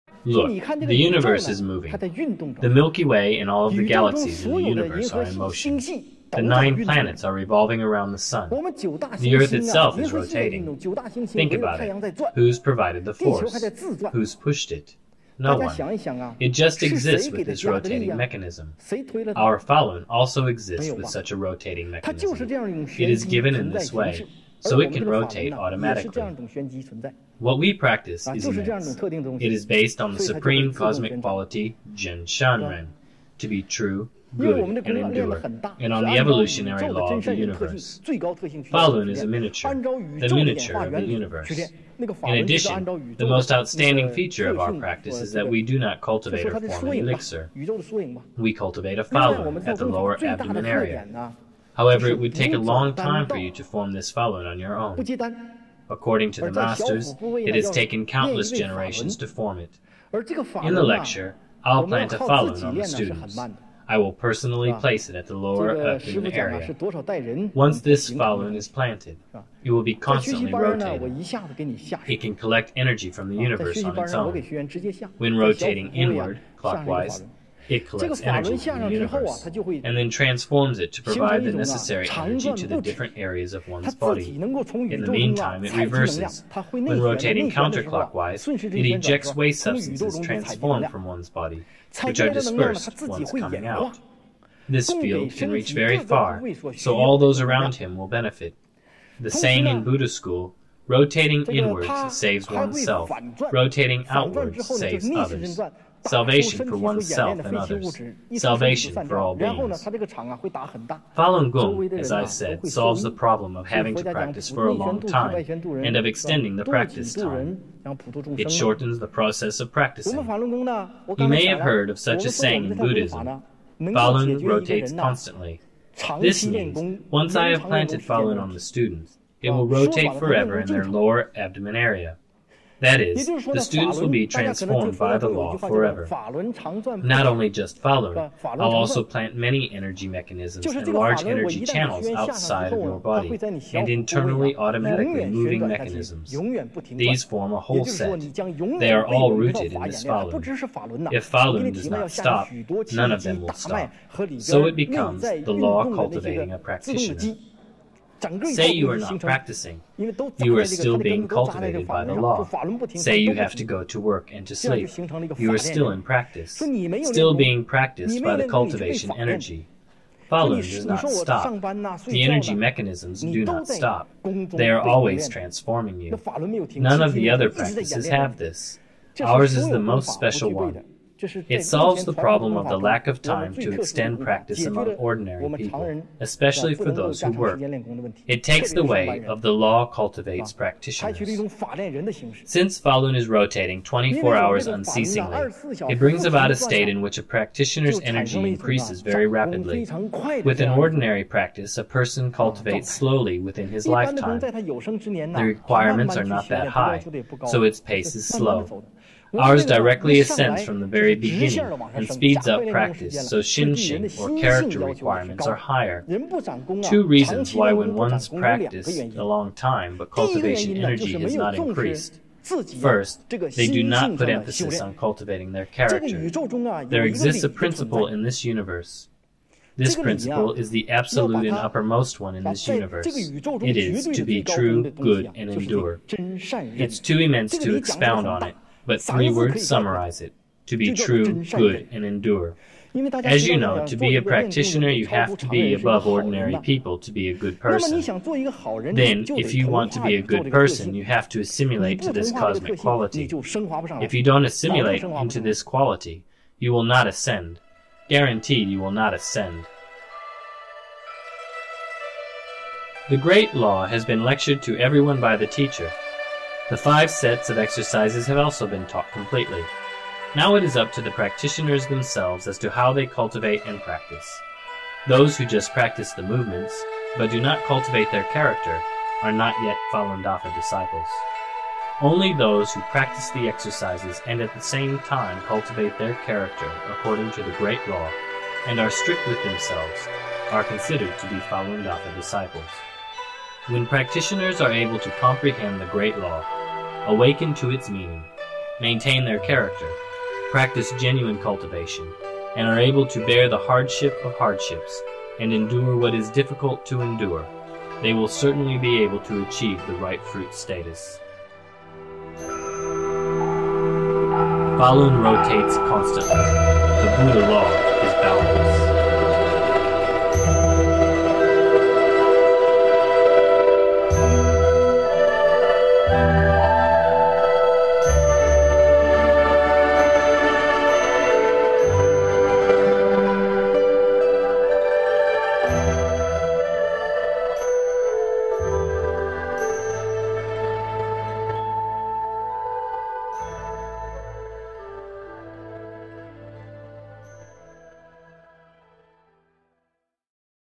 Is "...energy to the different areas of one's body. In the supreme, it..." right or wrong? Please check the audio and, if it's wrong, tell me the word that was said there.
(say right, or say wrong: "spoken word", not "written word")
wrong: "meantime", not "supreme".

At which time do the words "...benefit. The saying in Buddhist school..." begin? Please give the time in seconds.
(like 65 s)
98 s.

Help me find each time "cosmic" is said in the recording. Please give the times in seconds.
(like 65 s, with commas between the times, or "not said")
30 s, 252 s.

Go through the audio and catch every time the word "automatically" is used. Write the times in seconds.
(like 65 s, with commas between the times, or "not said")
25 s, 144 s.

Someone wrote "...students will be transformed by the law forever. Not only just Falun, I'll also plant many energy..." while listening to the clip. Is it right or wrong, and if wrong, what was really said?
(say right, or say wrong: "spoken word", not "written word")
right.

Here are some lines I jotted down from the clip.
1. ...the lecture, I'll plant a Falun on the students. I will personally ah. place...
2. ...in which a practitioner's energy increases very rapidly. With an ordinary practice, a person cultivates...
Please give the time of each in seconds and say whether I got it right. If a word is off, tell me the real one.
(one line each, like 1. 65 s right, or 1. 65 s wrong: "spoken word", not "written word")
1. 60 s right
2. 196 s right.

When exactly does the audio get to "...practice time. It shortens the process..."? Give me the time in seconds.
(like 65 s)
116 s.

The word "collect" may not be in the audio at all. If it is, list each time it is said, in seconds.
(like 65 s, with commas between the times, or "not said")
72 s, 77 s.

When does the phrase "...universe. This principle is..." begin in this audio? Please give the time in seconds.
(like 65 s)
228 s.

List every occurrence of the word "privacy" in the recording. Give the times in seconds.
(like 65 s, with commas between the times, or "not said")
not said.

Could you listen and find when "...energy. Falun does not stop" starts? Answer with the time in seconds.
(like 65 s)
169 s.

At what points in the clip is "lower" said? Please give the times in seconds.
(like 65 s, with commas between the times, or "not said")
49 s, 65 s, 130 s.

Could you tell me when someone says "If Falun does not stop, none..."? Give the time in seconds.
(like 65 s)
151 s.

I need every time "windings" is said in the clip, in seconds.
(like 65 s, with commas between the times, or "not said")
not said.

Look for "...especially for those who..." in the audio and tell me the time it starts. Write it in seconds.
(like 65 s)
186 s.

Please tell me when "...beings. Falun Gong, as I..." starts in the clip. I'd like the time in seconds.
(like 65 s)
109 s.